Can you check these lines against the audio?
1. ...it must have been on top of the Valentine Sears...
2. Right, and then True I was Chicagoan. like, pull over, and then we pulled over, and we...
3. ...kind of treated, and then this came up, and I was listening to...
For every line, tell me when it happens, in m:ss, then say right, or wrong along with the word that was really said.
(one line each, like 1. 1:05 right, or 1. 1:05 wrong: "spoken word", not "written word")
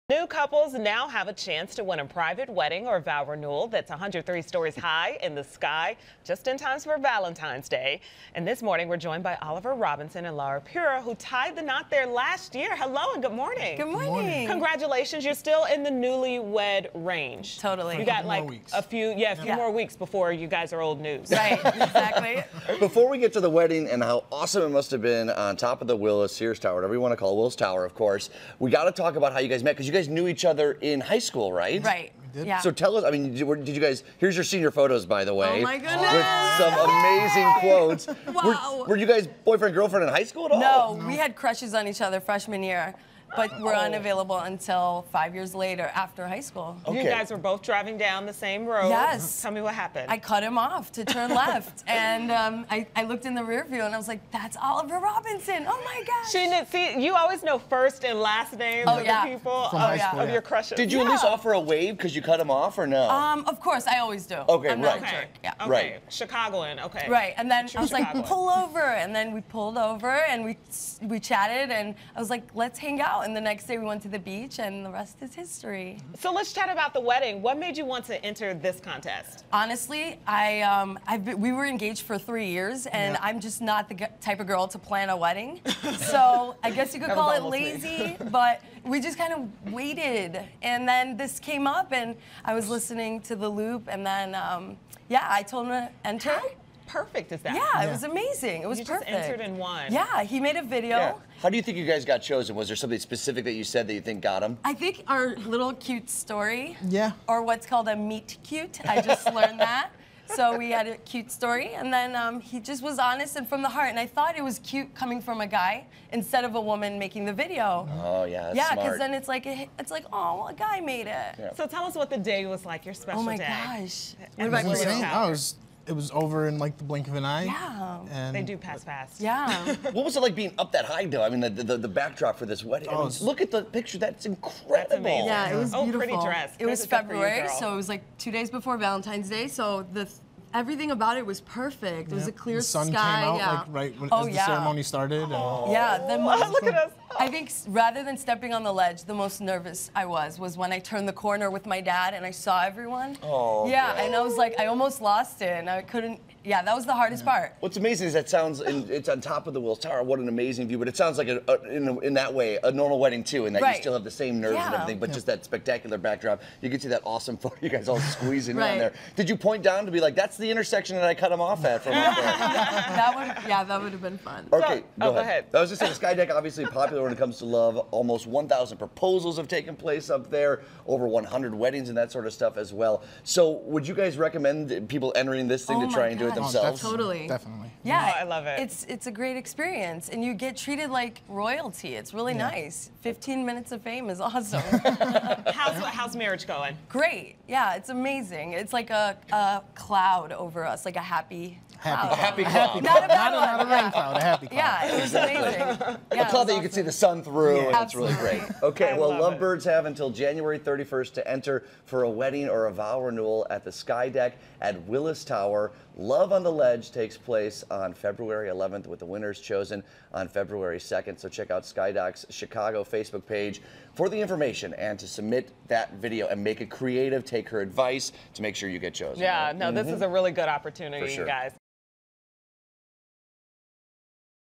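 1. 0:24 wrong: "Willis", not "Valentine"
2. 1:07 right
3. 1:29 wrong: "waited", not "treated".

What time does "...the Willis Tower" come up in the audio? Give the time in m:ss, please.
2:39.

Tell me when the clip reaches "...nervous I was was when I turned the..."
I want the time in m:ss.
2:29.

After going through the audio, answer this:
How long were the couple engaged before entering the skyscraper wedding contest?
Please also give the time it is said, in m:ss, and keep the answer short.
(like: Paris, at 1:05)
3 years, at 1:22.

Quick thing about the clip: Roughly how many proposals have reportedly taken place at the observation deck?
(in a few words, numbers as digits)
Almost 1,000.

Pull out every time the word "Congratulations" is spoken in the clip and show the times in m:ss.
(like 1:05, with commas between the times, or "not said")
0:14.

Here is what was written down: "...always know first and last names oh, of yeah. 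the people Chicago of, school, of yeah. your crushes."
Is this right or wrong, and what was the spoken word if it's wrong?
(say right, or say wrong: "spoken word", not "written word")
wrong: "From", not "Chicago".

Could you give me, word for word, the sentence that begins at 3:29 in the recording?
have until January 31st to enter for a wedding or a vow renewal at the Skydeck at Willis Tower.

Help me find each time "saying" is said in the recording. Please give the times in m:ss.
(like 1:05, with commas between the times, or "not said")
2:55.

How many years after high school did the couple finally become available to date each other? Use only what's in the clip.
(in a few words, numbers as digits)
5.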